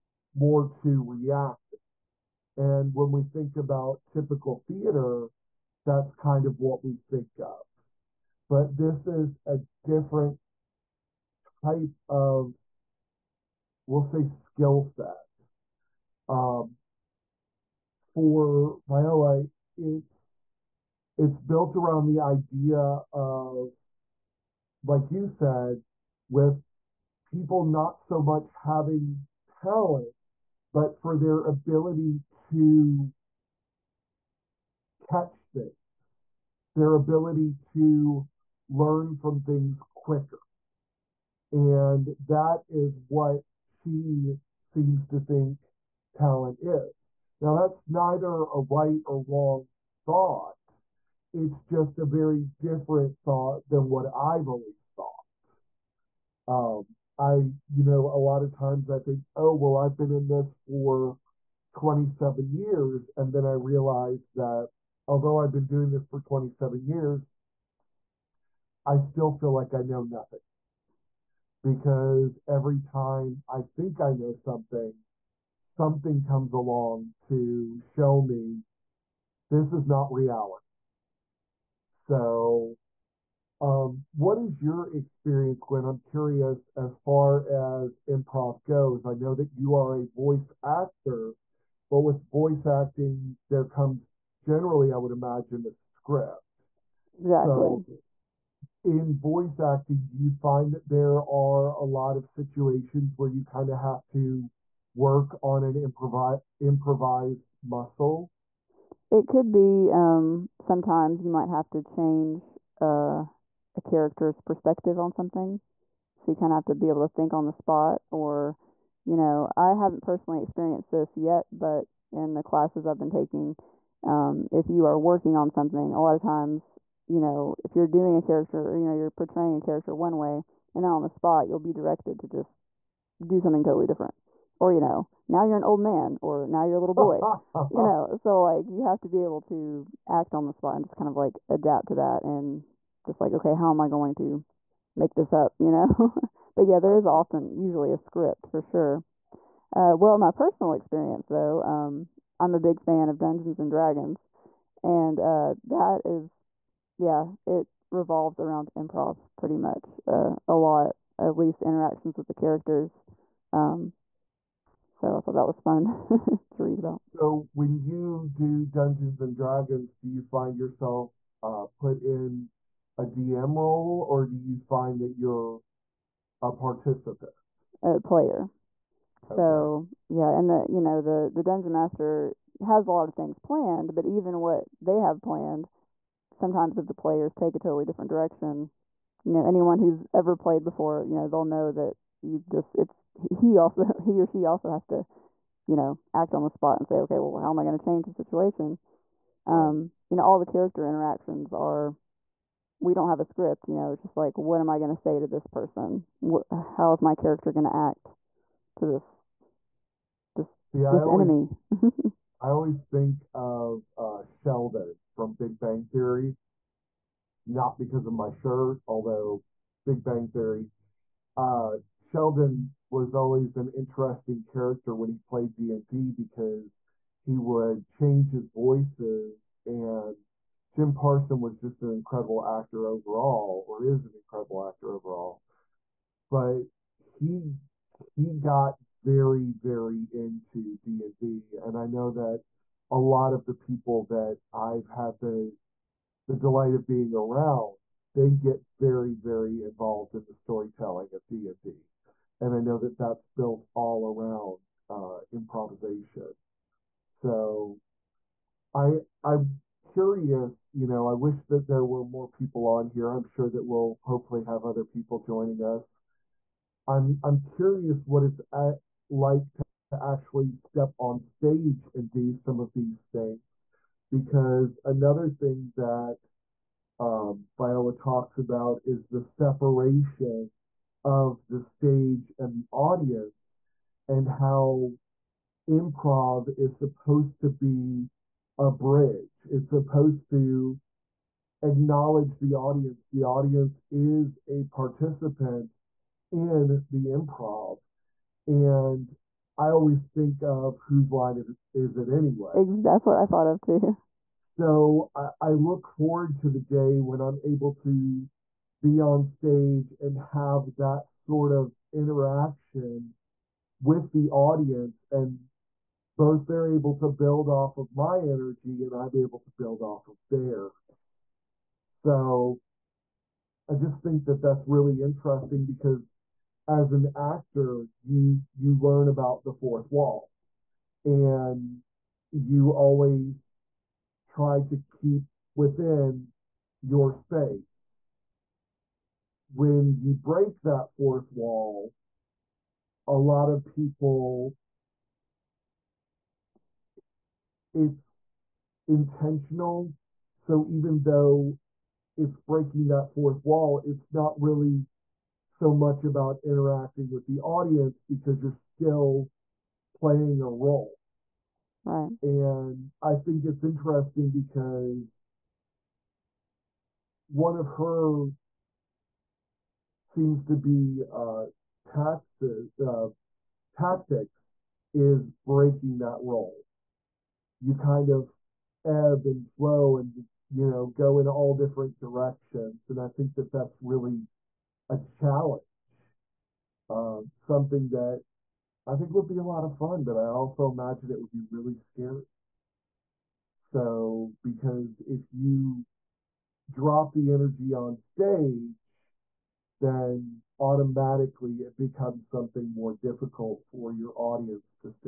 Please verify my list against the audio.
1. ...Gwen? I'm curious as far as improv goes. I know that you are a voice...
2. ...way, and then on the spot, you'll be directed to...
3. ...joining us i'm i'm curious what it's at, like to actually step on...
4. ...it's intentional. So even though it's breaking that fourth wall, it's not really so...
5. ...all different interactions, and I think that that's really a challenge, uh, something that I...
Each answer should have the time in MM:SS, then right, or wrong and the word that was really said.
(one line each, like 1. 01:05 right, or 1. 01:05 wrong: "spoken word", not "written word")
1. 01:25 right
2. 02:10 right
3. 04:25 right
4. 05:47 right
5. 06:21 wrong: "directions", not "interactions".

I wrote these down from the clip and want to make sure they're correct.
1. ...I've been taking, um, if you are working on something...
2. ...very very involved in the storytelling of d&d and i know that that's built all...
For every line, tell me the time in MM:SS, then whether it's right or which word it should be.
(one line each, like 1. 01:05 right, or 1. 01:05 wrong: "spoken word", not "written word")
1. 02:02 right
2. 04:08 right.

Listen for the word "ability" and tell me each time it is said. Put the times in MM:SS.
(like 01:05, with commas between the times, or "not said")
00:31, 00:36.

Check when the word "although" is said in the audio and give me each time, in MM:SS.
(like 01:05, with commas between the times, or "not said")
01:05, 03:38.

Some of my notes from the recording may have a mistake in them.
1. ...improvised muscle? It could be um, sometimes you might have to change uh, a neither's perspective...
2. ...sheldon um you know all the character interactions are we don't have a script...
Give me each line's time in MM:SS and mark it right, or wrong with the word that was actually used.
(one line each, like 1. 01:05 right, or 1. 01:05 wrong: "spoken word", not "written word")
1. 01:46 wrong: "character", not "neither"
2. 03:18 wrong: "situation", not "sheldon".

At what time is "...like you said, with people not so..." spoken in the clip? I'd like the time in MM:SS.
00:24.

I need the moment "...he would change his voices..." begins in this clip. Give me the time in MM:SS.
03:47.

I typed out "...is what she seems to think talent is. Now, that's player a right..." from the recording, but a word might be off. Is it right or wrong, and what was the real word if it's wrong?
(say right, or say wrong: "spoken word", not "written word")
wrong: "neither", not "player".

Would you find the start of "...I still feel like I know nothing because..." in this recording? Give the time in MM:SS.
01:08.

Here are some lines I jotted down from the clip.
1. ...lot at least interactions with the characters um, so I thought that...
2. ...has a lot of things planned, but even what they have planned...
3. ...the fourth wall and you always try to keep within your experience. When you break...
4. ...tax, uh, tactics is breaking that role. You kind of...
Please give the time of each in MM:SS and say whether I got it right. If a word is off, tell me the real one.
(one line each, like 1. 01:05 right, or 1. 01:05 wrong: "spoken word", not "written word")
1. 02:40 right
2. 03:02 right
3. 05:29 wrong: "space", not "experience"
4. 06:11 right.